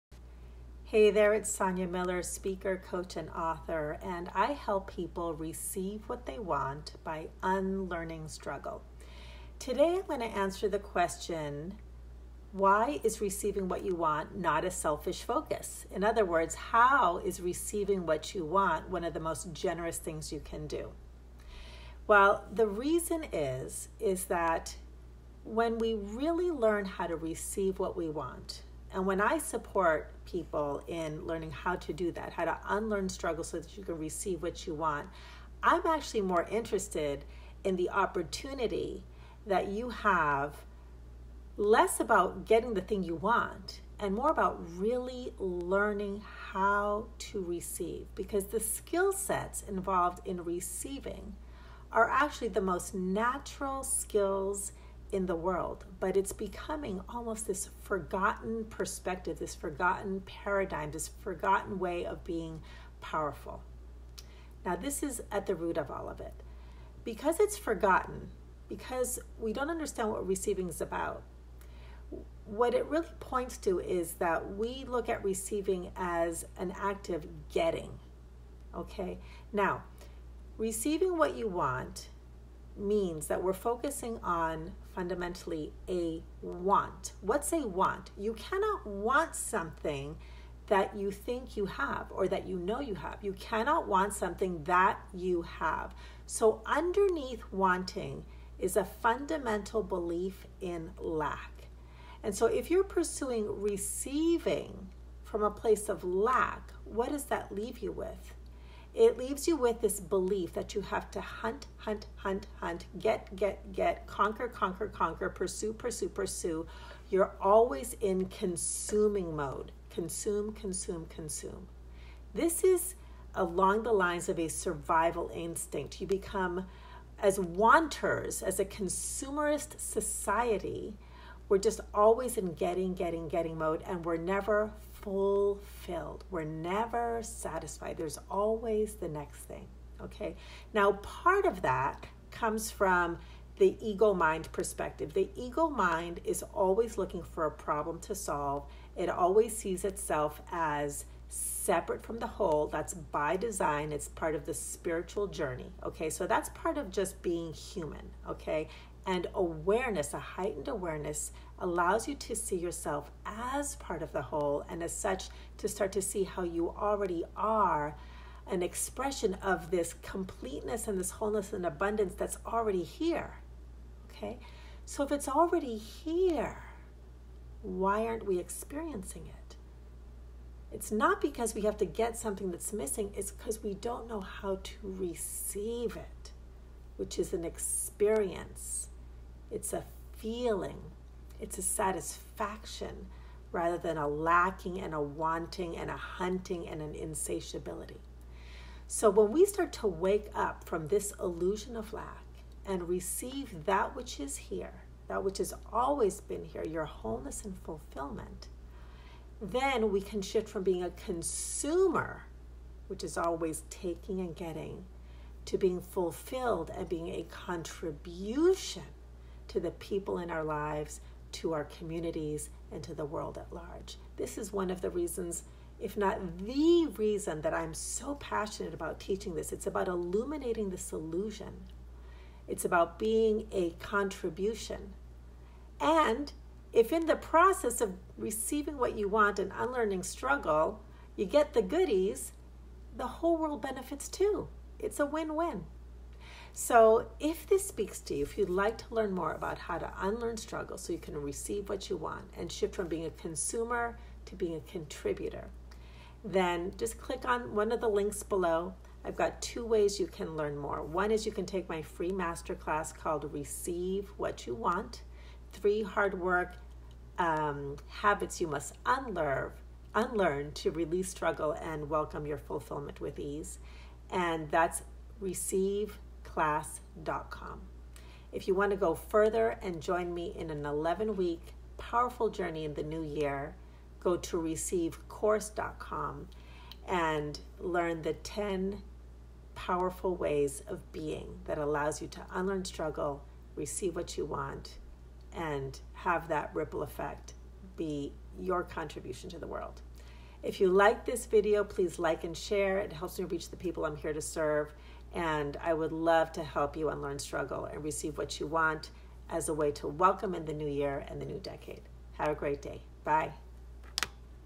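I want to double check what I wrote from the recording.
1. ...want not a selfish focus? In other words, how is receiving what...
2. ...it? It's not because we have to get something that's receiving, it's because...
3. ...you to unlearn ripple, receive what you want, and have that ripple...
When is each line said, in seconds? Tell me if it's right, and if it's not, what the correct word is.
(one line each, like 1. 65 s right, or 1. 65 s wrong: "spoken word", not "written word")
1. 13 s right
2. 179 s wrong: "missing", not "receiving"
3. 292 s wrong: "struggle", not "ripple".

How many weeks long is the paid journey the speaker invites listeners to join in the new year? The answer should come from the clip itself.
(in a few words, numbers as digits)
11 weeks.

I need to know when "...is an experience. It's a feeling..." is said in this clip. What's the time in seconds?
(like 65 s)
187 s.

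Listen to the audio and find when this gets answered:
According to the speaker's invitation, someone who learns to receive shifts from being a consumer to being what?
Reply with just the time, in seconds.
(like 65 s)
254 s.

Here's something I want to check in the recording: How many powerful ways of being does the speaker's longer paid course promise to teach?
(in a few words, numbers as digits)
10.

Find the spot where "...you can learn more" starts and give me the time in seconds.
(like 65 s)
259 s.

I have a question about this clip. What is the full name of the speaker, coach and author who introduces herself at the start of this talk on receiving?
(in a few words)
Sonia Miller.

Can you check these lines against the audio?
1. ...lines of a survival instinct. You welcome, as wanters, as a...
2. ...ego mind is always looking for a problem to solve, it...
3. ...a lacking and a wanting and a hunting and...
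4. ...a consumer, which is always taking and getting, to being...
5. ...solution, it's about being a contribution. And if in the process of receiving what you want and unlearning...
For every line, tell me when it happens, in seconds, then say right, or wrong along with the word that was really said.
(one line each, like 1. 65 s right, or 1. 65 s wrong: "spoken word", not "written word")
1. 123 s wrong: "become", not "welcome"
2. 145 s right
3. 193 s right
4. 210 s right
5. 230 s right.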